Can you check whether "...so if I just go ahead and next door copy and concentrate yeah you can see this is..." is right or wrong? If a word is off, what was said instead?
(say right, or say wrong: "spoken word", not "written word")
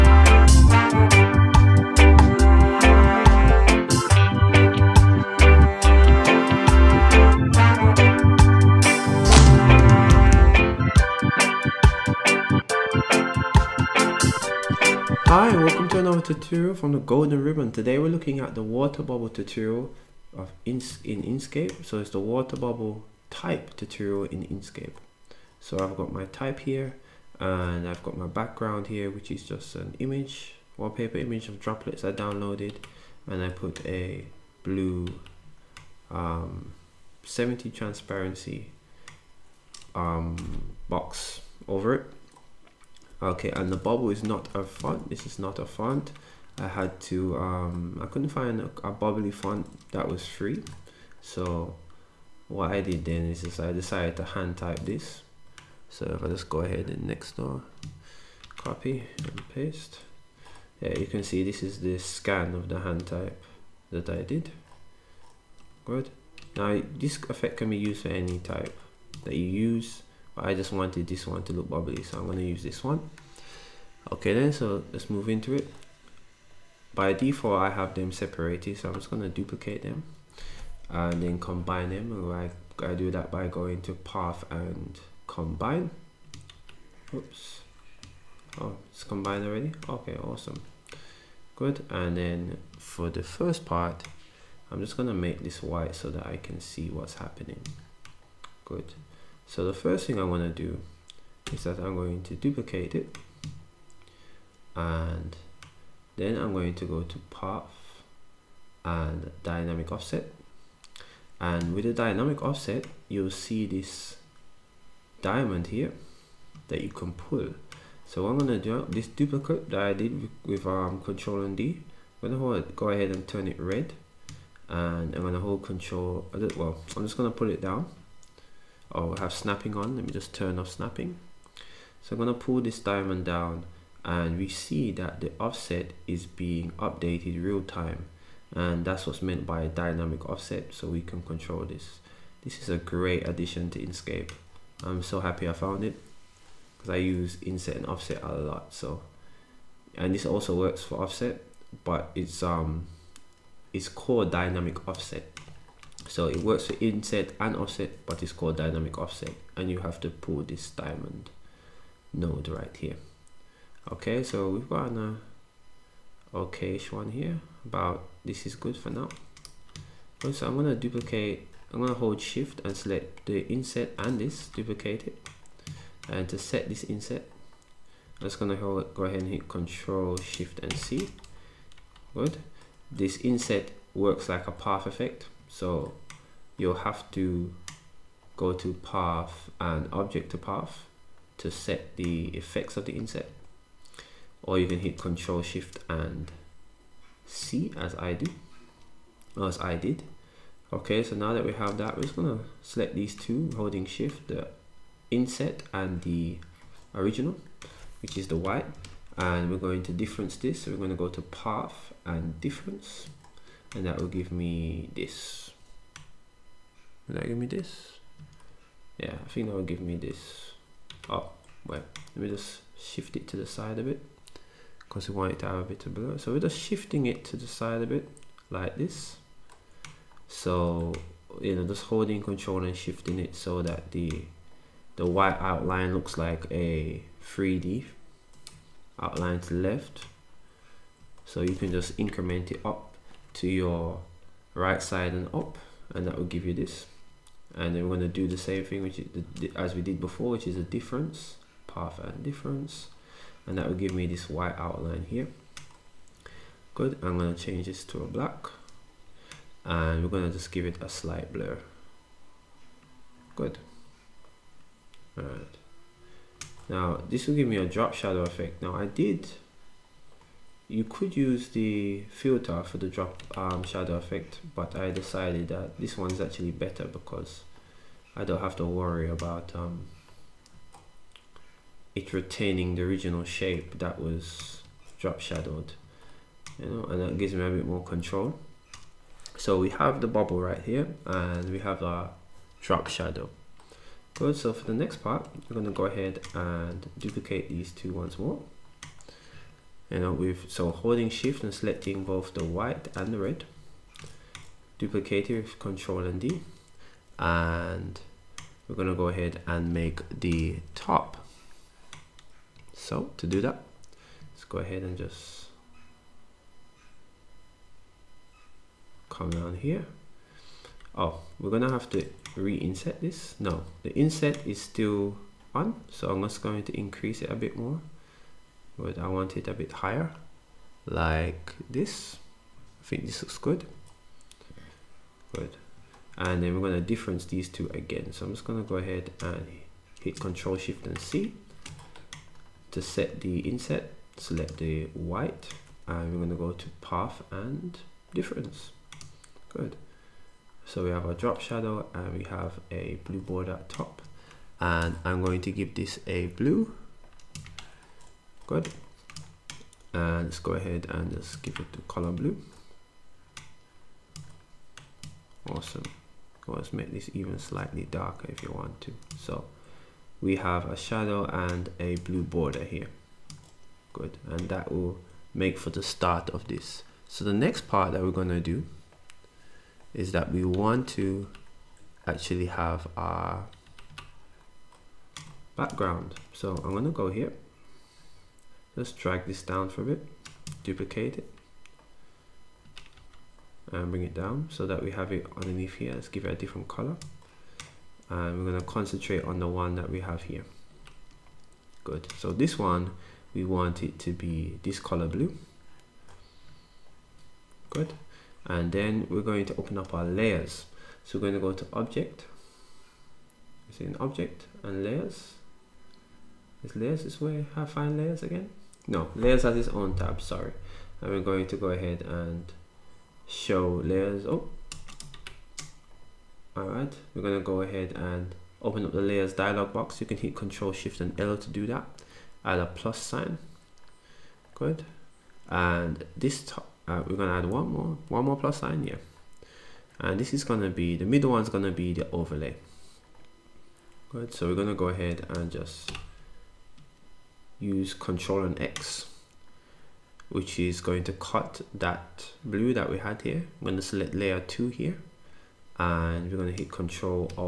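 wrong: "paste", not "concentrate".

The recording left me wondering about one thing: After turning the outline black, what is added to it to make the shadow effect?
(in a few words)
slight blur.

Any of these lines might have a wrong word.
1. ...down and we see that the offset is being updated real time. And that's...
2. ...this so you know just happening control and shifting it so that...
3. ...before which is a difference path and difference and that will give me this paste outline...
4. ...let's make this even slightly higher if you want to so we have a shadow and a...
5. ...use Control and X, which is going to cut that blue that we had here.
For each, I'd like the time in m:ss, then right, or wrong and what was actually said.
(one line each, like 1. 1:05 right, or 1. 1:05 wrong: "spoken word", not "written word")
1. 2:13 right
2. 3:48 wrong: "holding", not "happening"
3. 4:10 wrong: "white", not "paste"
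4. 6:06 wrong: "darker", not "higher"
5. 7:27 right.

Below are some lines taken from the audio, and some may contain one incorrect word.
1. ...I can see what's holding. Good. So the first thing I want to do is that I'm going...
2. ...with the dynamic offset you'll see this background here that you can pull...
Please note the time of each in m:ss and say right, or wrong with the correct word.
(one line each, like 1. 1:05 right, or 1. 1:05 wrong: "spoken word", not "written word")
1. 1:36 wrong: "happening", not "holding"
2. 1:51 wrong: "diamond", not "background".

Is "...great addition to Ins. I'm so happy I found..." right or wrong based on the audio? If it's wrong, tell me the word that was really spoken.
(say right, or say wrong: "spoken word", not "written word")
wrong: "Inkscape", not "Ins".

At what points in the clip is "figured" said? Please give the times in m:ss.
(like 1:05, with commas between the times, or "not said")
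not said.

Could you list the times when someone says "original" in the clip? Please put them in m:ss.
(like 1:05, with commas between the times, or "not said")
3:26, 4:42.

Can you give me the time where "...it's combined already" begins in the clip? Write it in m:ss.
1:28.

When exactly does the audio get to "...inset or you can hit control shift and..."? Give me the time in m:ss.
3:12.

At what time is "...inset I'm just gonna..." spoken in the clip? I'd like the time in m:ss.
2:56.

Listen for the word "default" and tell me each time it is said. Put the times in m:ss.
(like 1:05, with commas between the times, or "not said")
1:17.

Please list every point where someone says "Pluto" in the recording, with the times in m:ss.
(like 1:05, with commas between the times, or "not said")
not said.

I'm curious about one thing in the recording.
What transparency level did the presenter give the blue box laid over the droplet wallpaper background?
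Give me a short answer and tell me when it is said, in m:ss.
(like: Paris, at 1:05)
70, at 0:37.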